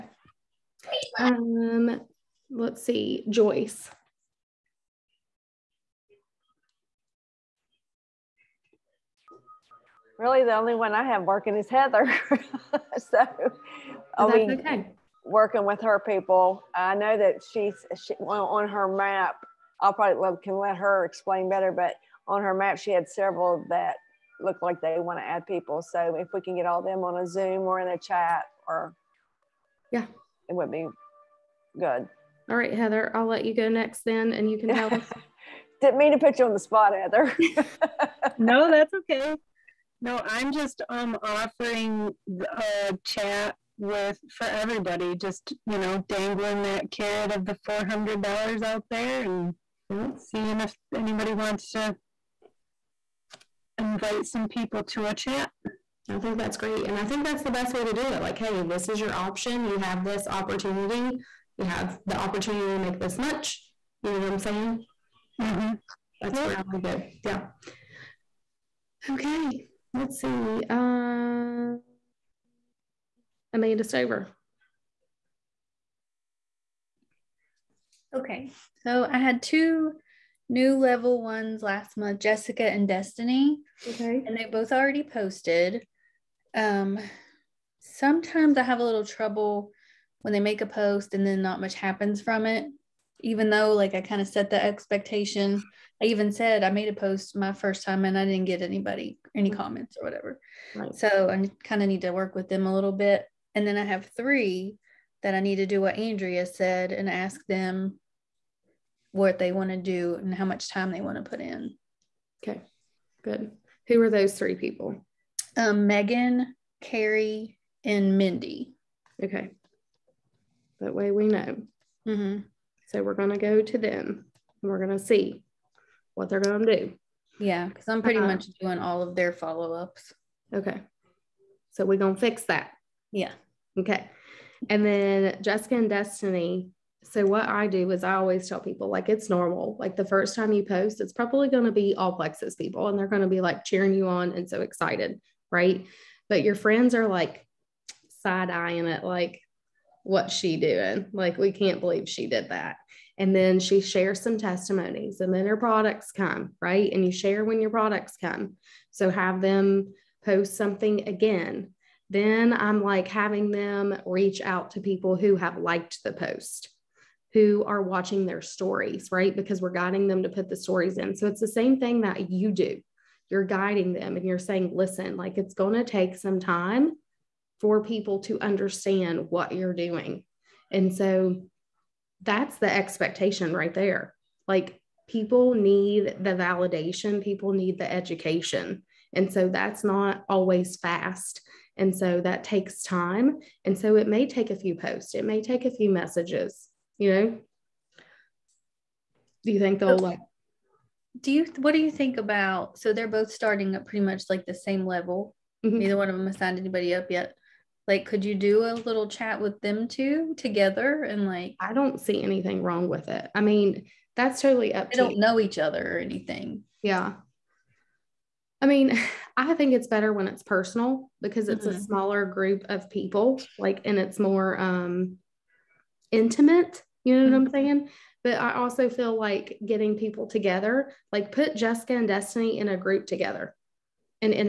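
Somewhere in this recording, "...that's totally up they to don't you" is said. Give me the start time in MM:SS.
03:34.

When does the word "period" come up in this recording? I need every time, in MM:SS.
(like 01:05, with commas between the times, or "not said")
not said.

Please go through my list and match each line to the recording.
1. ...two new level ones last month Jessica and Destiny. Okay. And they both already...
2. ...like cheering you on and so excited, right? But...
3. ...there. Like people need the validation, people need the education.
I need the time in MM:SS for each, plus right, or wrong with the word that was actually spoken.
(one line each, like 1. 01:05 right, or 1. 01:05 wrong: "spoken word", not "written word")
1. 01:19 right
2. 02:23 right
3. 03:03 right.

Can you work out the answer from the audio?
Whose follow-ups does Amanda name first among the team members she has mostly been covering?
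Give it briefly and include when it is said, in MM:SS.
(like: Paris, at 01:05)
Megan, at 01:55.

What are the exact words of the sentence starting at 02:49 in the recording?
Because we're guiding them to put the stories in.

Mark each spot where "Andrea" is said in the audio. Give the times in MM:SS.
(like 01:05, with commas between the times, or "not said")
01:45.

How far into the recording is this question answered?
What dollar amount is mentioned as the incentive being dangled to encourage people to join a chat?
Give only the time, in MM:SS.
00:47.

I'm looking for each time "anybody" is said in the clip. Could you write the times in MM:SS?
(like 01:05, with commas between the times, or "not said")
00:50, 01:38, 03:26.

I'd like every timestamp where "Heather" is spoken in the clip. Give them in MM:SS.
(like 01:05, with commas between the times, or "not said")
00:11, 00:32, 00:36.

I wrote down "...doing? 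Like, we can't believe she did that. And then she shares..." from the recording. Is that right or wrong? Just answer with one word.
right.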